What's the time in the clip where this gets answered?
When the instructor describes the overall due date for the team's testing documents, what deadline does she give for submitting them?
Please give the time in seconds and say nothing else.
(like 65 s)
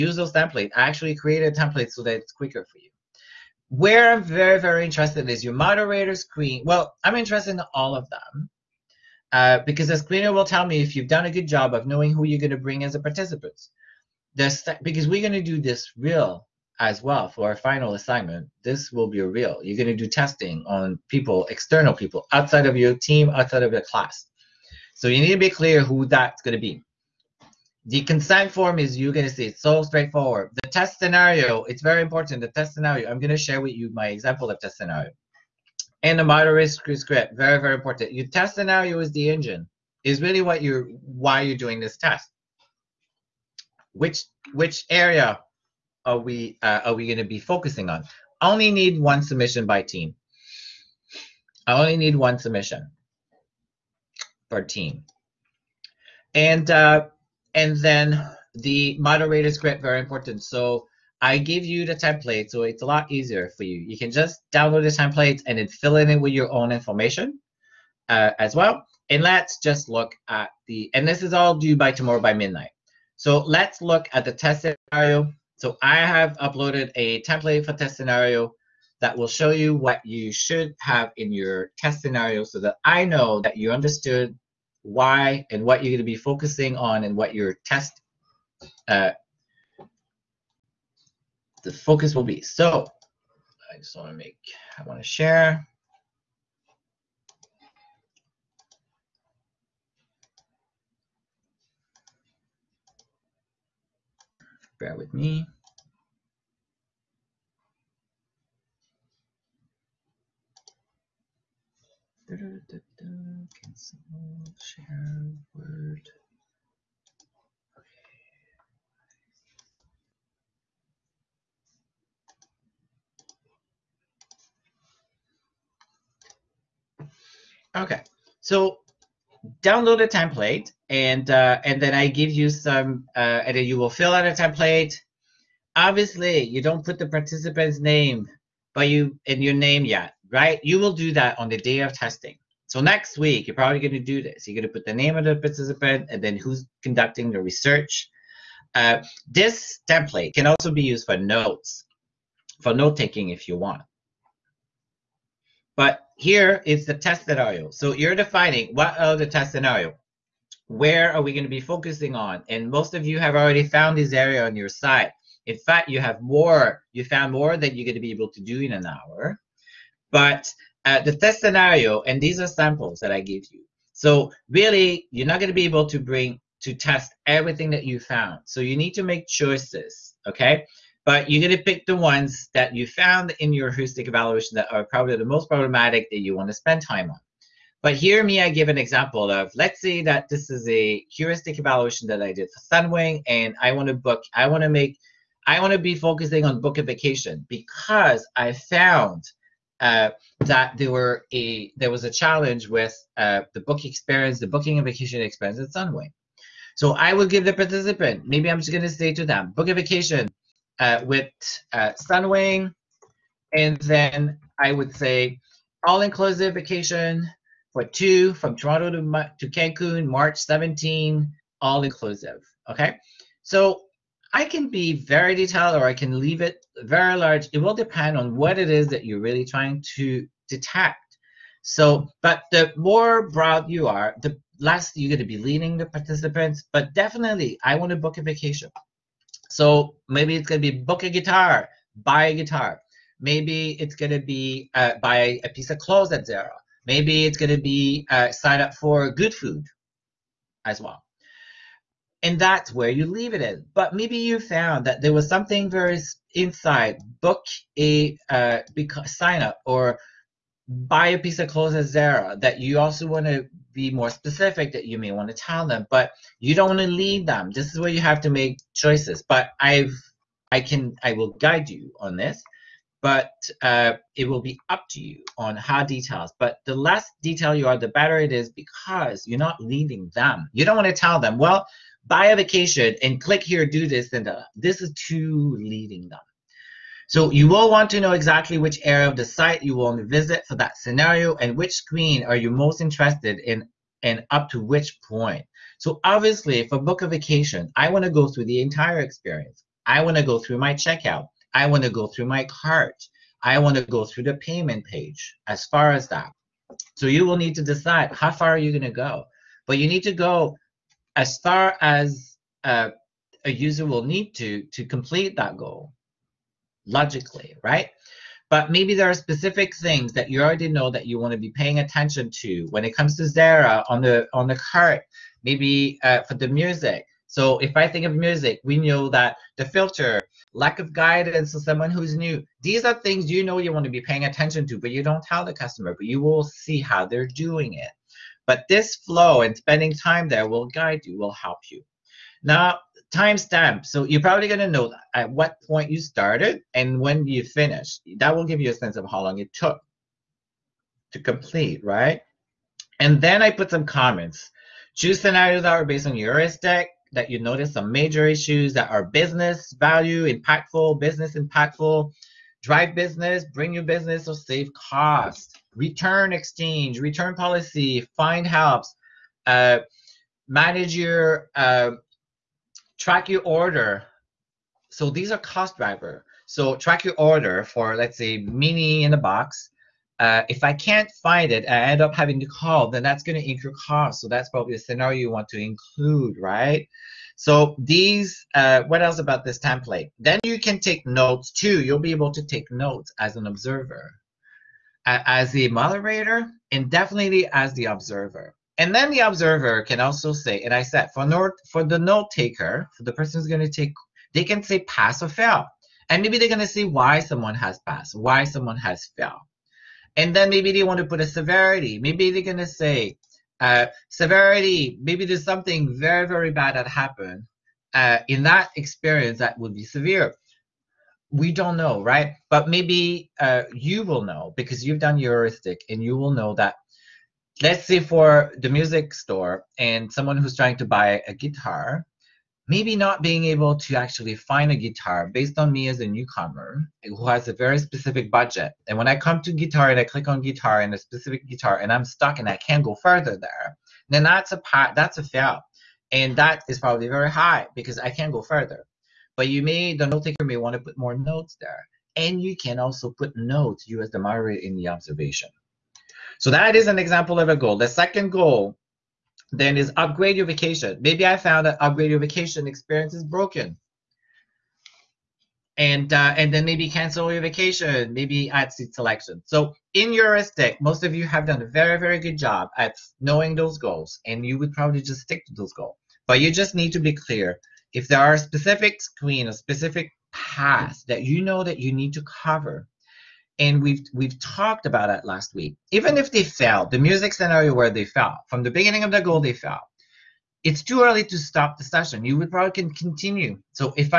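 71 s.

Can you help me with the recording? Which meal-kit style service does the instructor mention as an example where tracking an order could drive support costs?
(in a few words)
Mini in a box.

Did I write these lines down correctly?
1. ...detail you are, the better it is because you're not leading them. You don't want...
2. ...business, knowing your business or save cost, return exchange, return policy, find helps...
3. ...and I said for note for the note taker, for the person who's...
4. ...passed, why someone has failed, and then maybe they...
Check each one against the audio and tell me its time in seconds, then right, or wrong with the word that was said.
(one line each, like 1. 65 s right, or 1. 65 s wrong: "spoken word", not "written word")
1. 277 s right
2. 362 s wrong: "bring", not "knowing"
3. 400 s right
4. 407 s right.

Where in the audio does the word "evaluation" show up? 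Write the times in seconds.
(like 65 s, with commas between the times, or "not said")
184 s, 191 s.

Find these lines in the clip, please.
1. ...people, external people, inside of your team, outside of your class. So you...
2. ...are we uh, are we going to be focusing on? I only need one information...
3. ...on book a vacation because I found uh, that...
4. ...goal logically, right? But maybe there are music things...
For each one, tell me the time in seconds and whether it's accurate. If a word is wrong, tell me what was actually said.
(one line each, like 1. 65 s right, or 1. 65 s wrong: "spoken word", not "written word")
1. 21 s wrong: "outside", not "inside"
2. 46 s wrong: "submission", not "information"
3. 196 s right
4. 315 s wrong: "specific", not "music".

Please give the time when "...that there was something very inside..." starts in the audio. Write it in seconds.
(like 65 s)
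254 s.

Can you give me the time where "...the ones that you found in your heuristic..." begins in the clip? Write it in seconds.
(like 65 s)
181 s.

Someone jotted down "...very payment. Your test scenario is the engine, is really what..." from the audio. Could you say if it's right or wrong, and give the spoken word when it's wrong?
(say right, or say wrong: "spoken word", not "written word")
wrong: "important", not "payment".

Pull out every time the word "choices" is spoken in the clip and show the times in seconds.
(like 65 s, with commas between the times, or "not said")
179 s, 268 s.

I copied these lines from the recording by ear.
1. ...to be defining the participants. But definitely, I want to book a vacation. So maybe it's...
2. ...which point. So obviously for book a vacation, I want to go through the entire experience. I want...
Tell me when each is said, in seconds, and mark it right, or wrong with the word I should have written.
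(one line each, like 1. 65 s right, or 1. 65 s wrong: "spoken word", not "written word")
1. 235 s wrong: "leading", not "defining"
2. 294 s right.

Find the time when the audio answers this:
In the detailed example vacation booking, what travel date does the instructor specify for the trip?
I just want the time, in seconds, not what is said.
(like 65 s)
220 s.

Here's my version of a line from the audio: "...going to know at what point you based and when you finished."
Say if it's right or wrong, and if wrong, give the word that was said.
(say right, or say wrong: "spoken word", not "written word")
wrong: "started", not "based".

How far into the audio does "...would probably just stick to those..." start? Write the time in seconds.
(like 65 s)
474 s.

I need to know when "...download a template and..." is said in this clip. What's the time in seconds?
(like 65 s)
129 s.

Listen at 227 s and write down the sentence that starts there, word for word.
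It will depend on what it is that you're really trying to detect.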